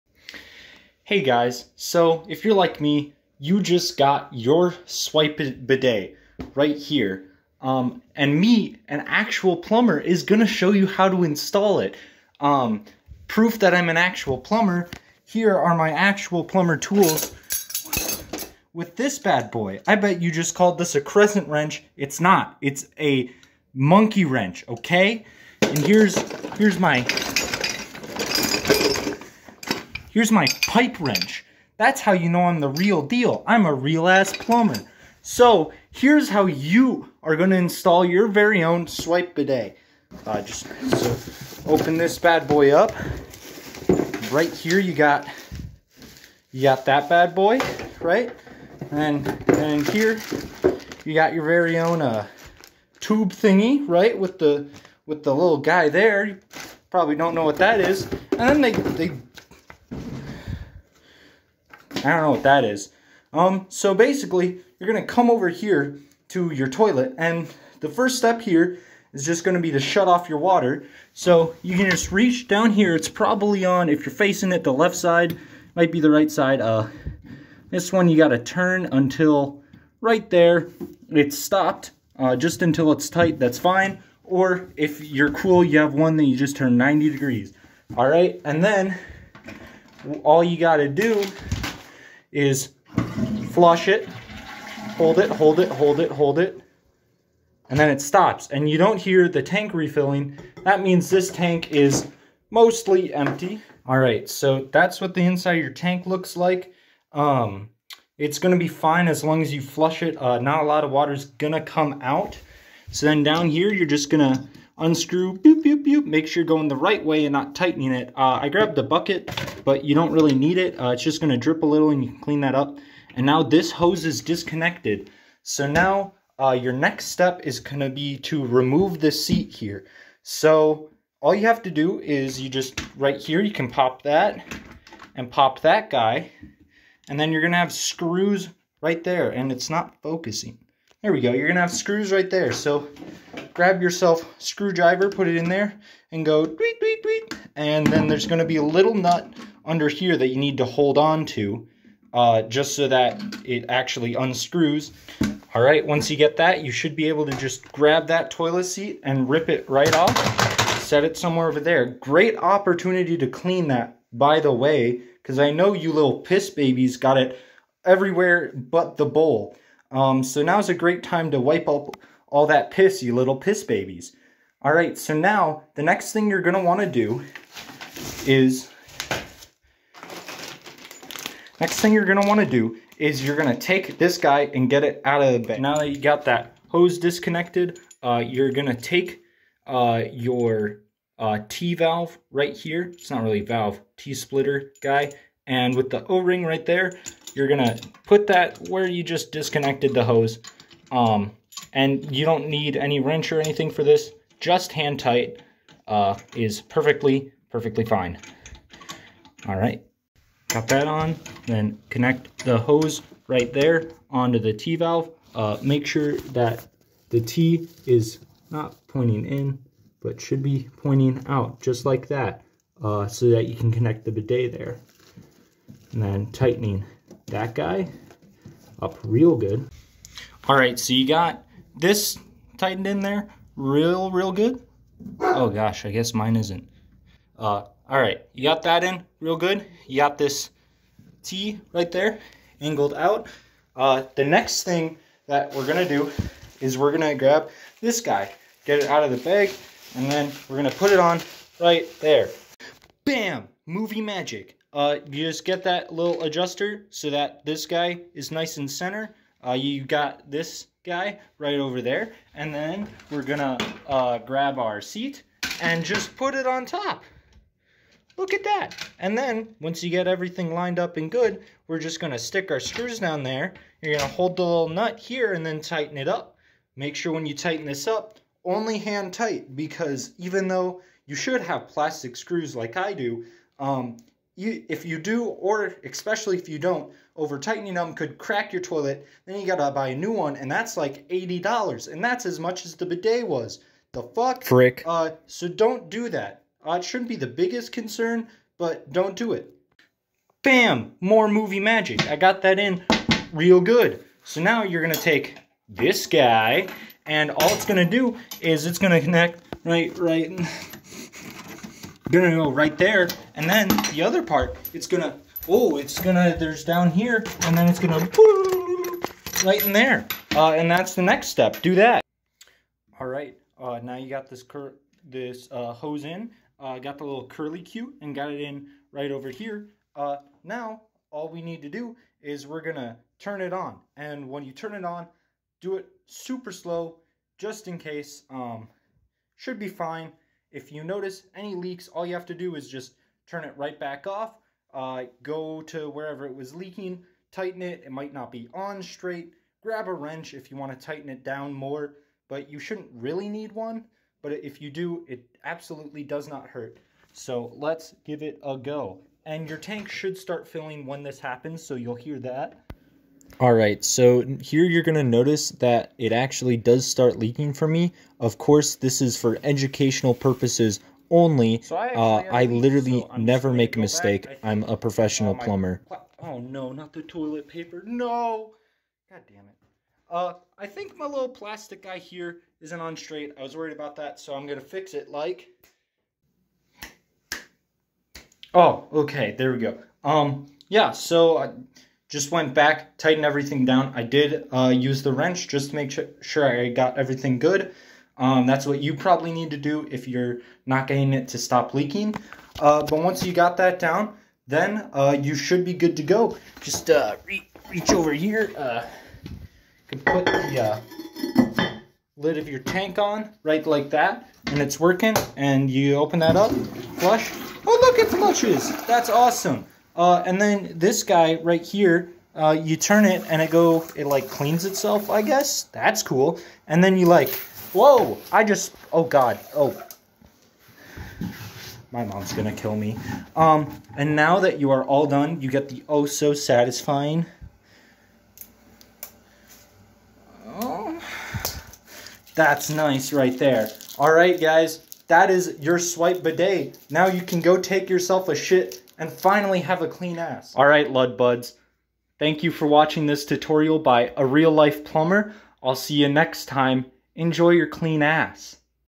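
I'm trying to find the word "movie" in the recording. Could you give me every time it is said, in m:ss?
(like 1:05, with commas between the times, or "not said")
4:13, 5:01.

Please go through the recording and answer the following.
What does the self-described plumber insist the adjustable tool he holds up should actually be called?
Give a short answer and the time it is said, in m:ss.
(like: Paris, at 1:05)
Monkey wrench, at 0:23.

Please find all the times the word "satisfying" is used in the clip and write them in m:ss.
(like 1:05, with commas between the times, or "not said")
7:16.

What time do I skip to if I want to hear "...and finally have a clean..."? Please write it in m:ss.
7:29.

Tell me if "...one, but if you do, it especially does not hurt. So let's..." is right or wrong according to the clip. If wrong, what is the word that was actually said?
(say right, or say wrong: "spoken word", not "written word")
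wrong: "absolutely", not "especially".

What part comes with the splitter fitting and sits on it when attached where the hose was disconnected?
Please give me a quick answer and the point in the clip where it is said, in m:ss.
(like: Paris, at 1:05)
O-ring, at 3:16.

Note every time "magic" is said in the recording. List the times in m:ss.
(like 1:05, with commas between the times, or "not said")
4:14, 5:01.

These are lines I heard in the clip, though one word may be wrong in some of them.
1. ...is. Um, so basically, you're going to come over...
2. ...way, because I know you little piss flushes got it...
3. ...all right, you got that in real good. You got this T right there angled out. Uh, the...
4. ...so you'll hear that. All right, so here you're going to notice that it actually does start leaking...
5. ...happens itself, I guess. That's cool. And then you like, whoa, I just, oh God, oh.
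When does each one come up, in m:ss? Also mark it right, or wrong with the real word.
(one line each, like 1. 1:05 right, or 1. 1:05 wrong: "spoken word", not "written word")
1. 1:02 right
2. 2:44 wrong: "babies", not "flushes"
3. 3:57 right
4. 6:01 right
5. 7:04 wrong: "cleans", not "happens".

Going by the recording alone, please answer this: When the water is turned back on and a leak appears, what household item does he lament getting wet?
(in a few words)
Toilet paper.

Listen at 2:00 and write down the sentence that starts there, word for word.
Uh, it's just going to drip a little and you can clean that up.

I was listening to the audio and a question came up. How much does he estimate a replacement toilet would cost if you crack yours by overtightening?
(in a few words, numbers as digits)
$80.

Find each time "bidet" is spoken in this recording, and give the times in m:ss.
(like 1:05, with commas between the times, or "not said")
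0:05, 0:39, 3:44, 4:52, 7:26.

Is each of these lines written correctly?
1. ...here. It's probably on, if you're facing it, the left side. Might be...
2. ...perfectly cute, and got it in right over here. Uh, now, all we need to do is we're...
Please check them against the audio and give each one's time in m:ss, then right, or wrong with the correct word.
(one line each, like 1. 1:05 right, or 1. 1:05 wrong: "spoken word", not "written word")
1. 1:12 right
2. 5:27 wrong: "curly", not "perfectly".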